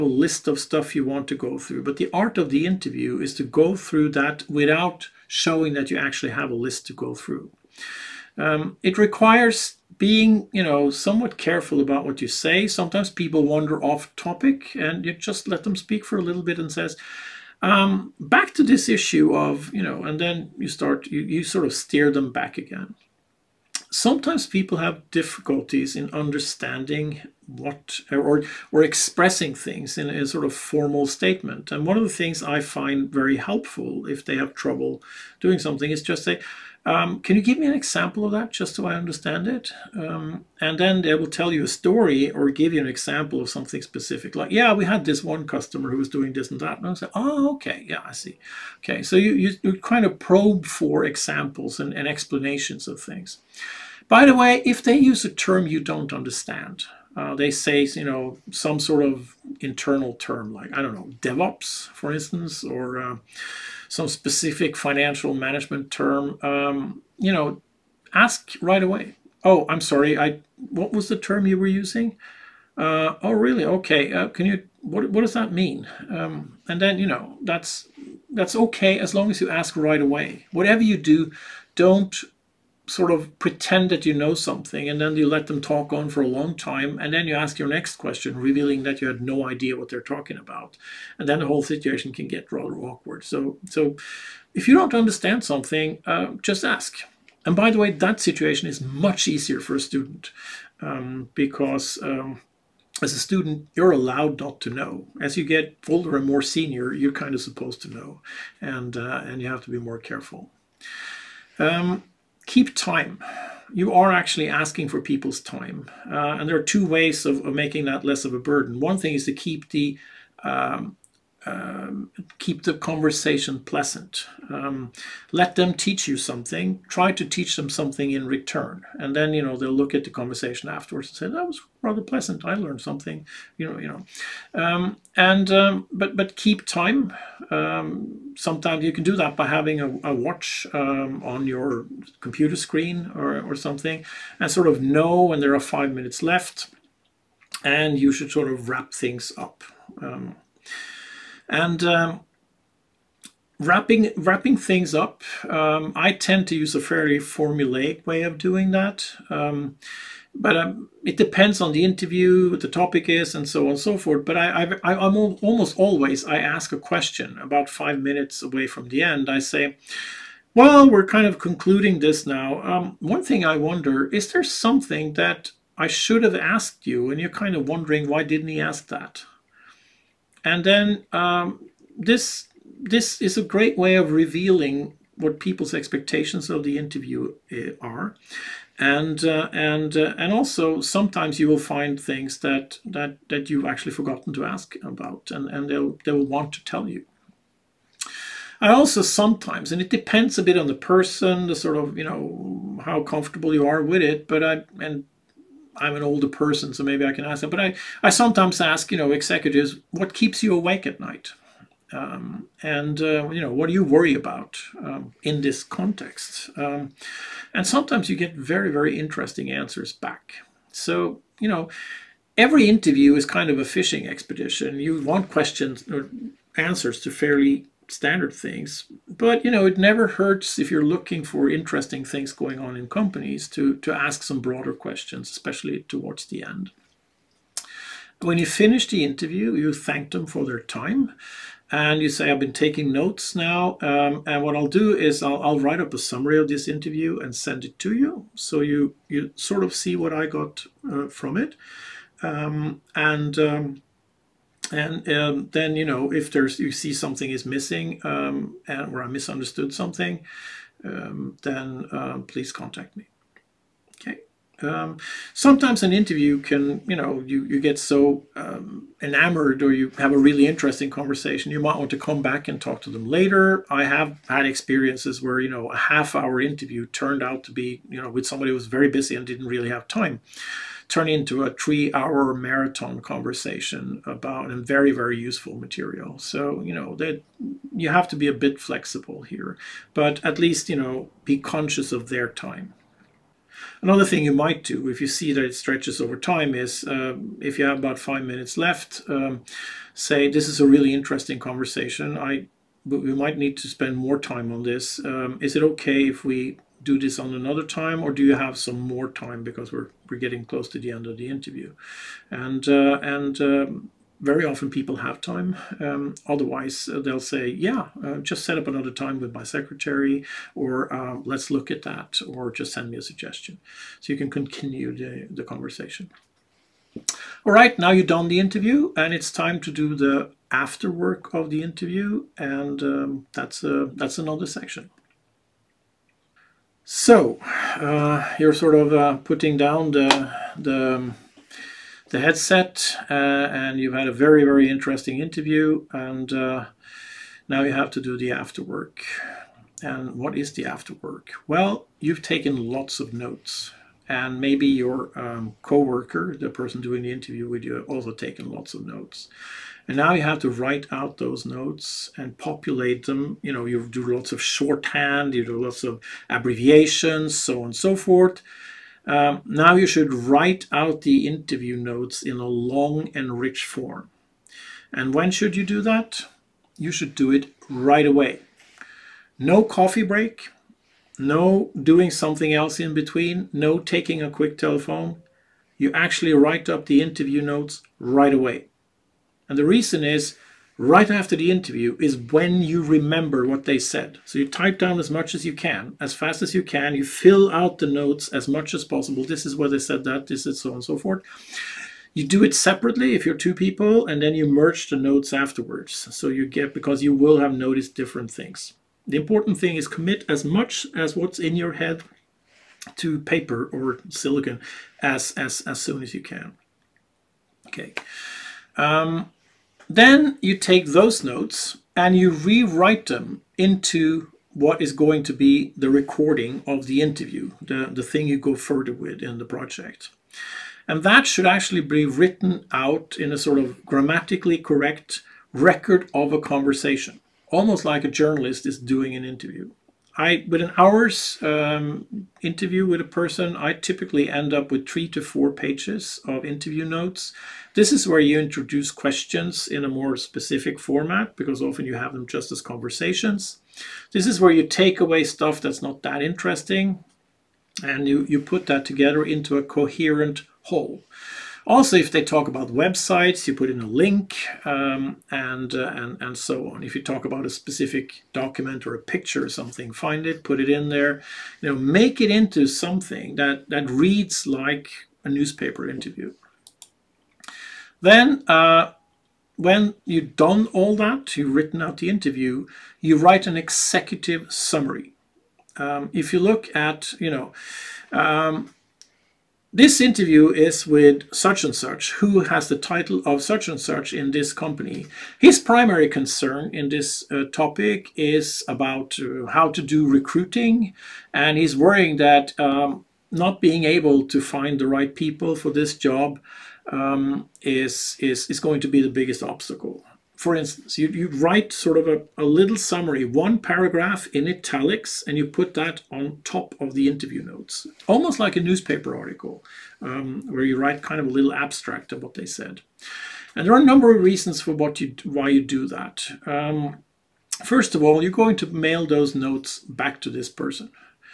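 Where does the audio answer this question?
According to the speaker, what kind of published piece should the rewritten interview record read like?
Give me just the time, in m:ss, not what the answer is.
7:55.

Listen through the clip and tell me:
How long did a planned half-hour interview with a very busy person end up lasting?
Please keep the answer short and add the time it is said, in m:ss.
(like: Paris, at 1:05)
3 hours, at 4:41.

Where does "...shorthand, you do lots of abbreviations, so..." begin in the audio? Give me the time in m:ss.
6:04.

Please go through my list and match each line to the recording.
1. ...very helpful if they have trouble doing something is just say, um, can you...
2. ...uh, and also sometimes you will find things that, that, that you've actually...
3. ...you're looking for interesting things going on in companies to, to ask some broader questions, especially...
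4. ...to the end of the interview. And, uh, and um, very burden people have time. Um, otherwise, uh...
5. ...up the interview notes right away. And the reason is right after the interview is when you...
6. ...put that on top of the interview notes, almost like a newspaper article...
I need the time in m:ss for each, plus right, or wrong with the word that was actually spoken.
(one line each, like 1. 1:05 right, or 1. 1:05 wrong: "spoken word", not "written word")
1. 0:33 right
2. 3:09 right
3. 3:50 right
4. 5:10 wrong: "often", not "burden"
5. 6:26 right
6. 8:35 right.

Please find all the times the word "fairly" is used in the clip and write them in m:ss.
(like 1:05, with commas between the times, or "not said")
2:36, 3:47.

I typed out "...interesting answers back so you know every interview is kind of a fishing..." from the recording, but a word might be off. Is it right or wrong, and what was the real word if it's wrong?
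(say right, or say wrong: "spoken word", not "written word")
right.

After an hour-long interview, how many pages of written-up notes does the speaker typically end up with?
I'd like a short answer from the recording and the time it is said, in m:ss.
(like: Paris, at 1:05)
3 to 4 pages, at 7:24.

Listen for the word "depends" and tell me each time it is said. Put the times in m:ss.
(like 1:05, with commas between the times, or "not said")
2:41, 3:19.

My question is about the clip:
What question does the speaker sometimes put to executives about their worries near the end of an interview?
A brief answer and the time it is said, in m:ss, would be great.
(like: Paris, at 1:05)
What keeps you awake at night?, at 3:29.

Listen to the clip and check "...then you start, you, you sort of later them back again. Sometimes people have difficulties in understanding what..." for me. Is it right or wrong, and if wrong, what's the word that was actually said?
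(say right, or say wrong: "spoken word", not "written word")
wrong: "steer", not "later".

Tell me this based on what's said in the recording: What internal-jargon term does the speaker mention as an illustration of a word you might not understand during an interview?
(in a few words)
DevOps.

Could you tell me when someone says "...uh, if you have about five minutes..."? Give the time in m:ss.
4:56.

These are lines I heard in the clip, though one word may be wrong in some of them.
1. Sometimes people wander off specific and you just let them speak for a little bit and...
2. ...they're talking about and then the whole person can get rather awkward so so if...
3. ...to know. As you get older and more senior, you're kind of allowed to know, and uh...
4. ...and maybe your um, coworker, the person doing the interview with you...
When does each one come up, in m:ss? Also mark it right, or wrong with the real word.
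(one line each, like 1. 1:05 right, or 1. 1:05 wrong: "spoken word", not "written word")
1. 0:12 wrong: "topic", not "specific"
2. 1:29 wrong: "situation", not "person"
3. 1:44 wrong: "supposed", not "allowed"
4. 5:54 right.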